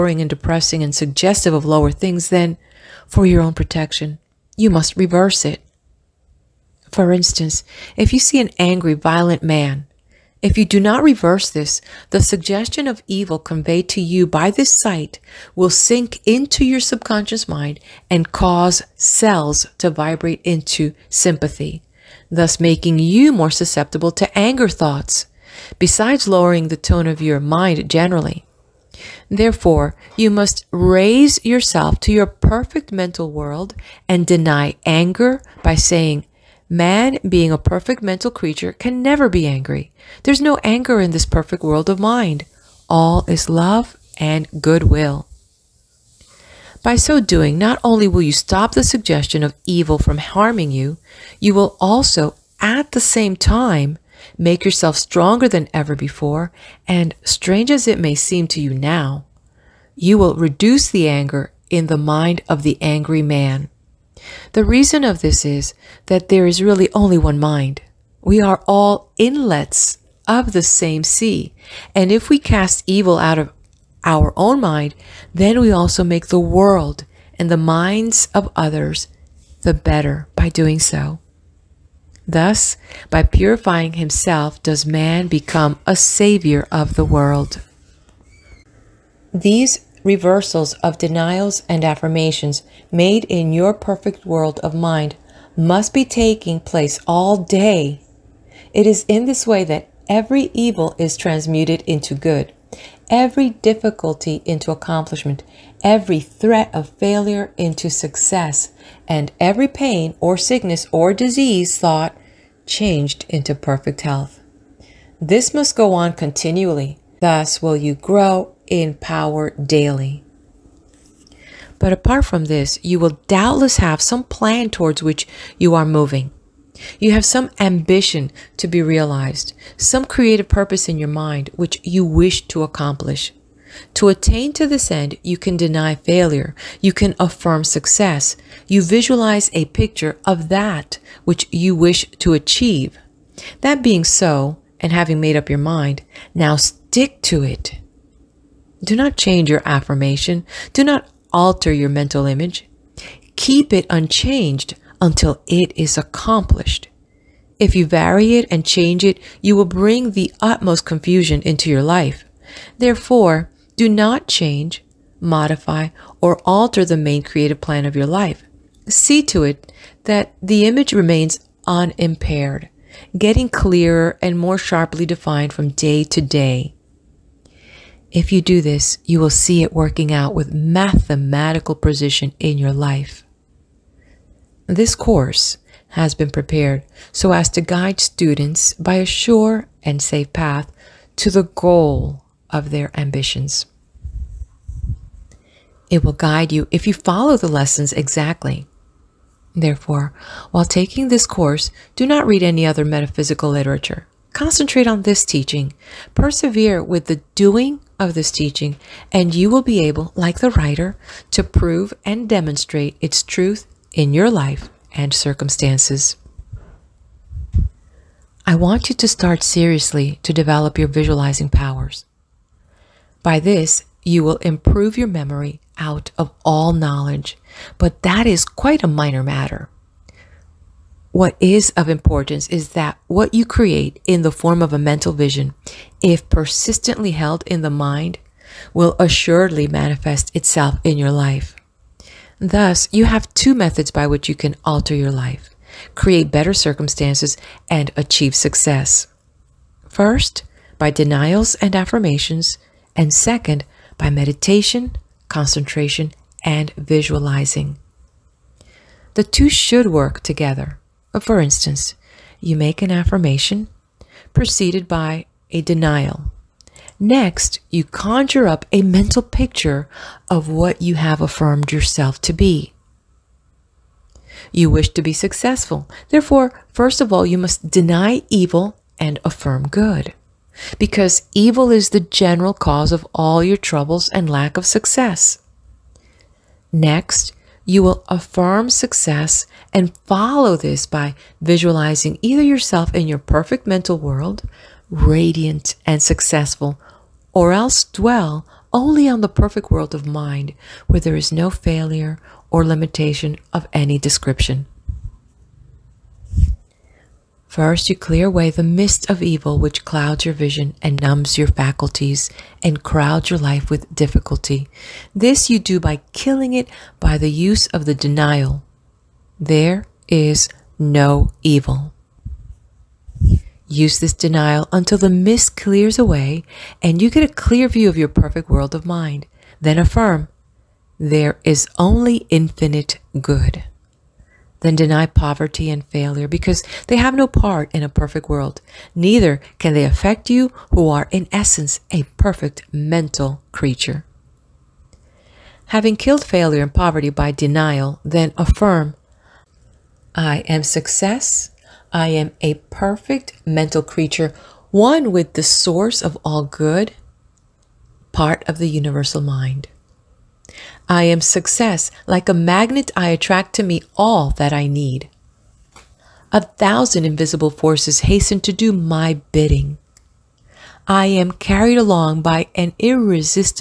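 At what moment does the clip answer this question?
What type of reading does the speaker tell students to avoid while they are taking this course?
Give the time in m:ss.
3:22.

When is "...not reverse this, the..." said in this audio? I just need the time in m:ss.
0:10.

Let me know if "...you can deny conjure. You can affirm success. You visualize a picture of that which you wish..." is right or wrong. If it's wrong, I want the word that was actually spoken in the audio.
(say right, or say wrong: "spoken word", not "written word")
wrong: "failure", not "conjure".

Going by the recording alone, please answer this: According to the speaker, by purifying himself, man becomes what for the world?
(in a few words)
a savior.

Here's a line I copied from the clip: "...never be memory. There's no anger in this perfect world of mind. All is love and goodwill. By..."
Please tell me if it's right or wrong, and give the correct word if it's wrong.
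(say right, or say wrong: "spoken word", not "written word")
wrong: "angry", not "memory".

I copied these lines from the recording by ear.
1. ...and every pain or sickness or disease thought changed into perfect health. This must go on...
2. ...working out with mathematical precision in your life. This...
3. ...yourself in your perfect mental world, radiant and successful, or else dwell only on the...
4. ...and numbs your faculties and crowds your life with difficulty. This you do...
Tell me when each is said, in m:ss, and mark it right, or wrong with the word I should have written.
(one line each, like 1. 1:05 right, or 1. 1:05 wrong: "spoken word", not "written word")
1. 1:49 right
2. 2:59 right
3. 4:52 right
4. 5:10 right.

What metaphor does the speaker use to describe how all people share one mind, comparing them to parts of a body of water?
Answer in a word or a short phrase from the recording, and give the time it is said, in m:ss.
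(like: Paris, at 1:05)
inlets of the same sea, at 1:09.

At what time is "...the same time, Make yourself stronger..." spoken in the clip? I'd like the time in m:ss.
0:52.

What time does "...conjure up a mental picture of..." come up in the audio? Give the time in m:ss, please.
4:27.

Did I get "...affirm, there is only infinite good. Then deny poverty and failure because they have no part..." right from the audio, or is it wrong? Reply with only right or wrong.
right.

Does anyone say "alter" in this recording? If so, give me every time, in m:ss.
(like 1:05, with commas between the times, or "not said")
2:31, 2:46, 4:04.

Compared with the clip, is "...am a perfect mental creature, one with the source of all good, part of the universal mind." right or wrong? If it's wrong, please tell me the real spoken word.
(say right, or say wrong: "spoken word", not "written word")
right.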